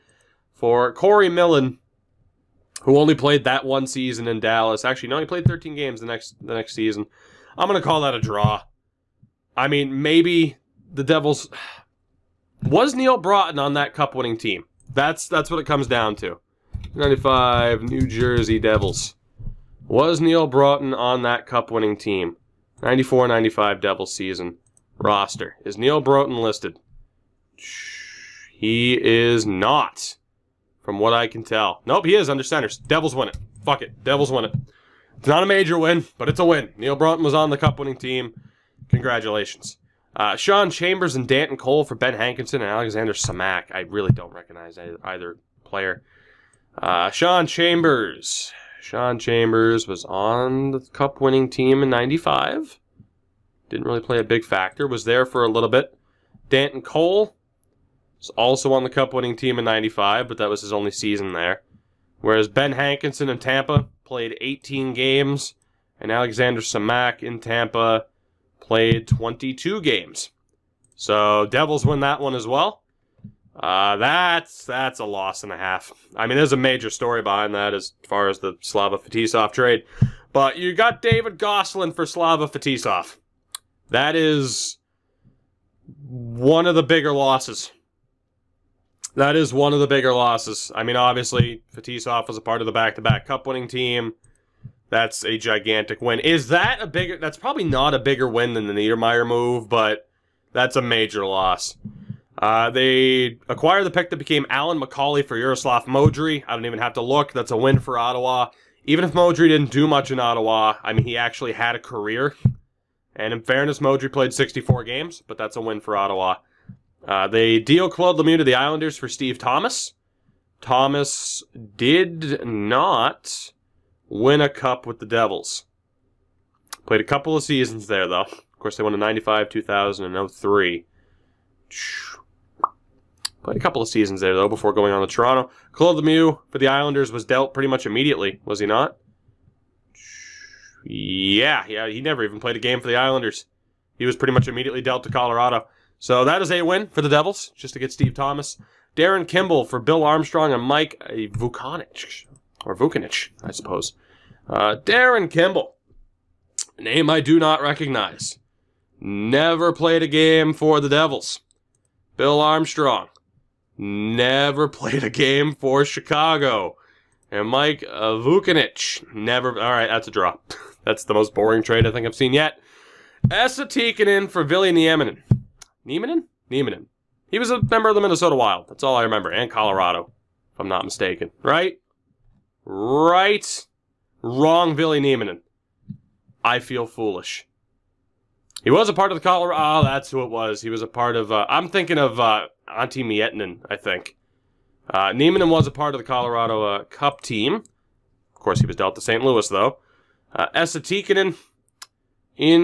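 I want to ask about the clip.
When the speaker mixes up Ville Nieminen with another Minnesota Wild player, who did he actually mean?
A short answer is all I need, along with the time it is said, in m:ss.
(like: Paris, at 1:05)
Antti Miettinen, at 3:12.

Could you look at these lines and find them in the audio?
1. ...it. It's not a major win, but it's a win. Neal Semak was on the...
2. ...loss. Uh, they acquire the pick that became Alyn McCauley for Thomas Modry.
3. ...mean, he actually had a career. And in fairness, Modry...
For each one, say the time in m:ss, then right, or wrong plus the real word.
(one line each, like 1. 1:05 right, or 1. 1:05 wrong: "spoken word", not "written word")
1. 0:34 wrong: "Broten", not "Semak"
2. 1:41 wrong: "Jaroslav", not "Thomas"
3. 1:50 right.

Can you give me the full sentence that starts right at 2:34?
Uh, Darren Kimball, name I do not recognize.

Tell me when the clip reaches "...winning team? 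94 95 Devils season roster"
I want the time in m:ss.
0:21.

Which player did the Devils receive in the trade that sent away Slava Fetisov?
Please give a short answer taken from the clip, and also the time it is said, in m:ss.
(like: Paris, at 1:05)
David Gosselin, at 1:21.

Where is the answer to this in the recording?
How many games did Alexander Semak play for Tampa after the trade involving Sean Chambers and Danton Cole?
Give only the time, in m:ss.
1:09.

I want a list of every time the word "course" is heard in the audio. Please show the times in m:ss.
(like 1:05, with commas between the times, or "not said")
2:08, 3:18.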